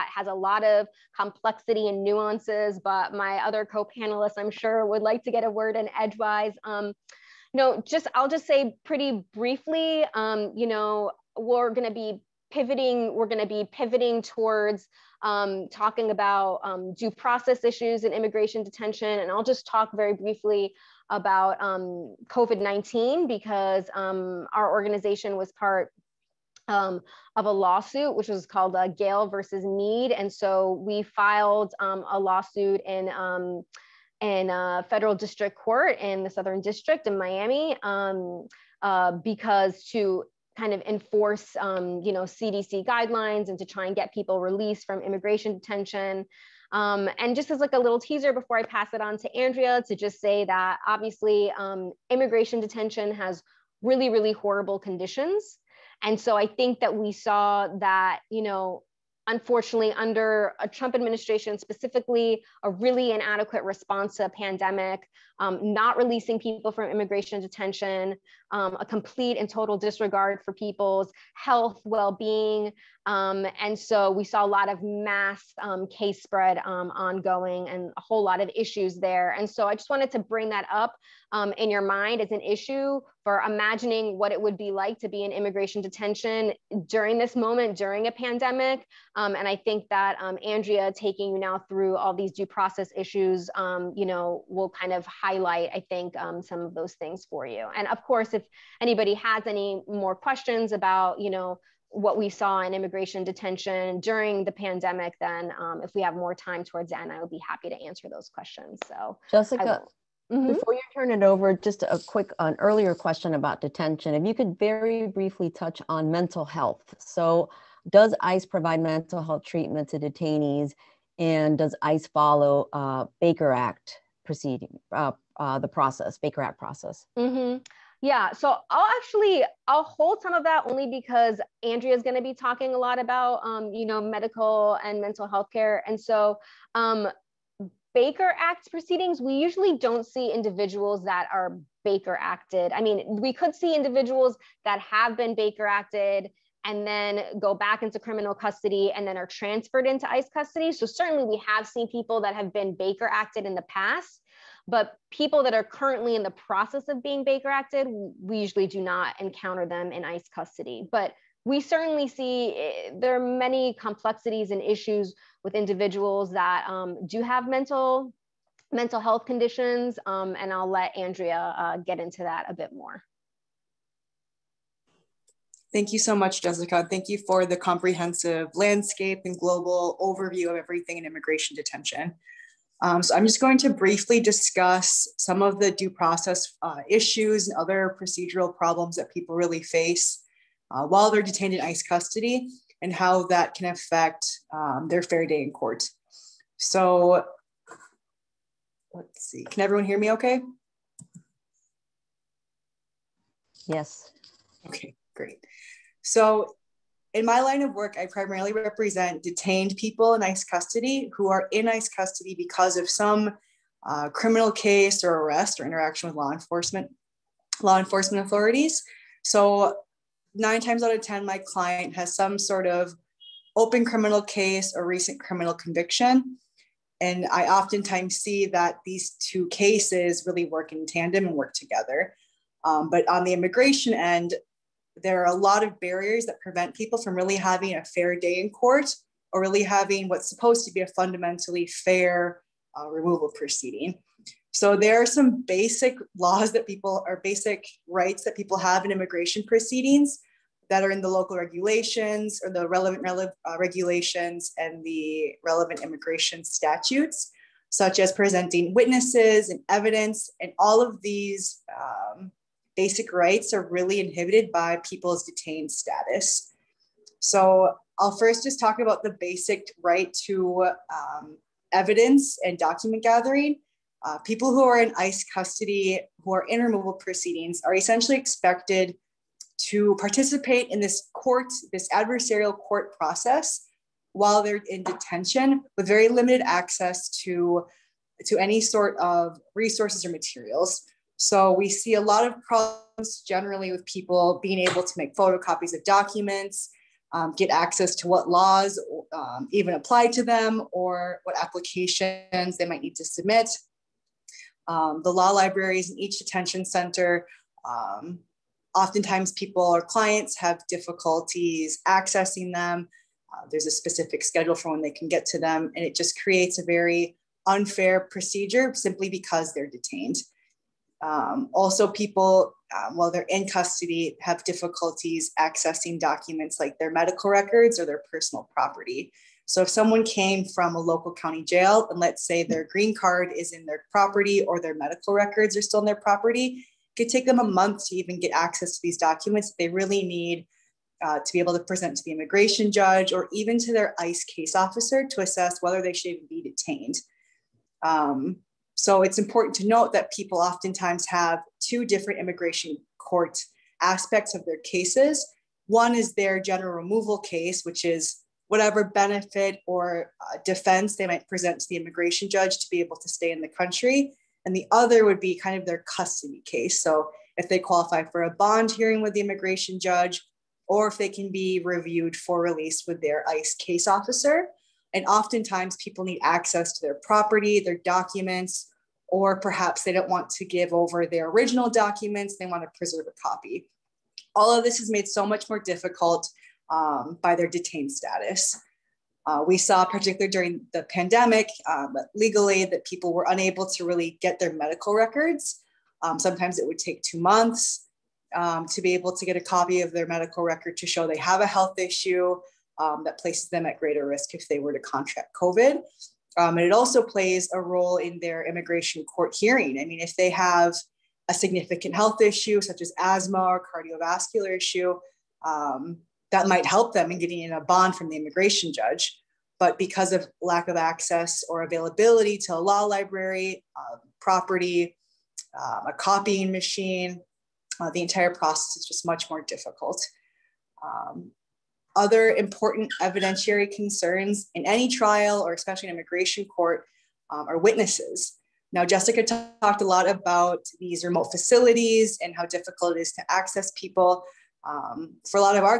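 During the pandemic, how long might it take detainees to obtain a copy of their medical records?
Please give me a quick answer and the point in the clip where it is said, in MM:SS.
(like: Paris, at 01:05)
2 months, at 06:37.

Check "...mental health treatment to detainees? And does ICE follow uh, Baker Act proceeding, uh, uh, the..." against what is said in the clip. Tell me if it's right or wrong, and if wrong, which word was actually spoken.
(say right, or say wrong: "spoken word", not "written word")
right.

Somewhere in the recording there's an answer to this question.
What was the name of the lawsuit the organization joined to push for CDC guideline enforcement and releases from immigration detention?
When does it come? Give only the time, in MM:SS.
00:28.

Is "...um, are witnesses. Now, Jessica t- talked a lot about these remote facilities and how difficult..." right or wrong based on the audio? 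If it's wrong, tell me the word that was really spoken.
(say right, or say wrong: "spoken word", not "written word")
right.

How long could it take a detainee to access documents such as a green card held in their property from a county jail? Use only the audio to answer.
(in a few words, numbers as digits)
a month.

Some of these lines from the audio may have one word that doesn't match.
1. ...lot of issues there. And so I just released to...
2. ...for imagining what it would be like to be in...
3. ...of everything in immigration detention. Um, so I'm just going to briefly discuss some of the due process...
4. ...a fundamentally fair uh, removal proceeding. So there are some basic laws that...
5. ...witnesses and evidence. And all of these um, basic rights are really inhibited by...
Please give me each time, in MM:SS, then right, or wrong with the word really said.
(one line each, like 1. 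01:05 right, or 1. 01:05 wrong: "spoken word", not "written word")
1. 01:18 wrong: "wanted", not "released"
2. 01:23 right
3. 03:00 right
4. 04:00 right
5. 04:18 right.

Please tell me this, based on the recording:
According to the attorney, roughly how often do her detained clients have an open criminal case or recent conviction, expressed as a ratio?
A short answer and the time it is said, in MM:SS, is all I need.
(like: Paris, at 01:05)
9 out of 10, at 03:40.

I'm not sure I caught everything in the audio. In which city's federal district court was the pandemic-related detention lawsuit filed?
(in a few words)
Miami.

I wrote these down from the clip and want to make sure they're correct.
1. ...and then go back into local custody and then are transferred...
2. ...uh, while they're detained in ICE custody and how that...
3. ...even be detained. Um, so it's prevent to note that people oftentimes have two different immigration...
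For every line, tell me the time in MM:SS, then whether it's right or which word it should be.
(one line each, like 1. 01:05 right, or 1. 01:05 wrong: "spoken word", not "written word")
1. 02:26 wrong: "criminal", not "local"
2. 03:10 right
3. 05:46 wrong: "important", not "prevent".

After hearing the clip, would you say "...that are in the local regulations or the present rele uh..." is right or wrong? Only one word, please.
wrong.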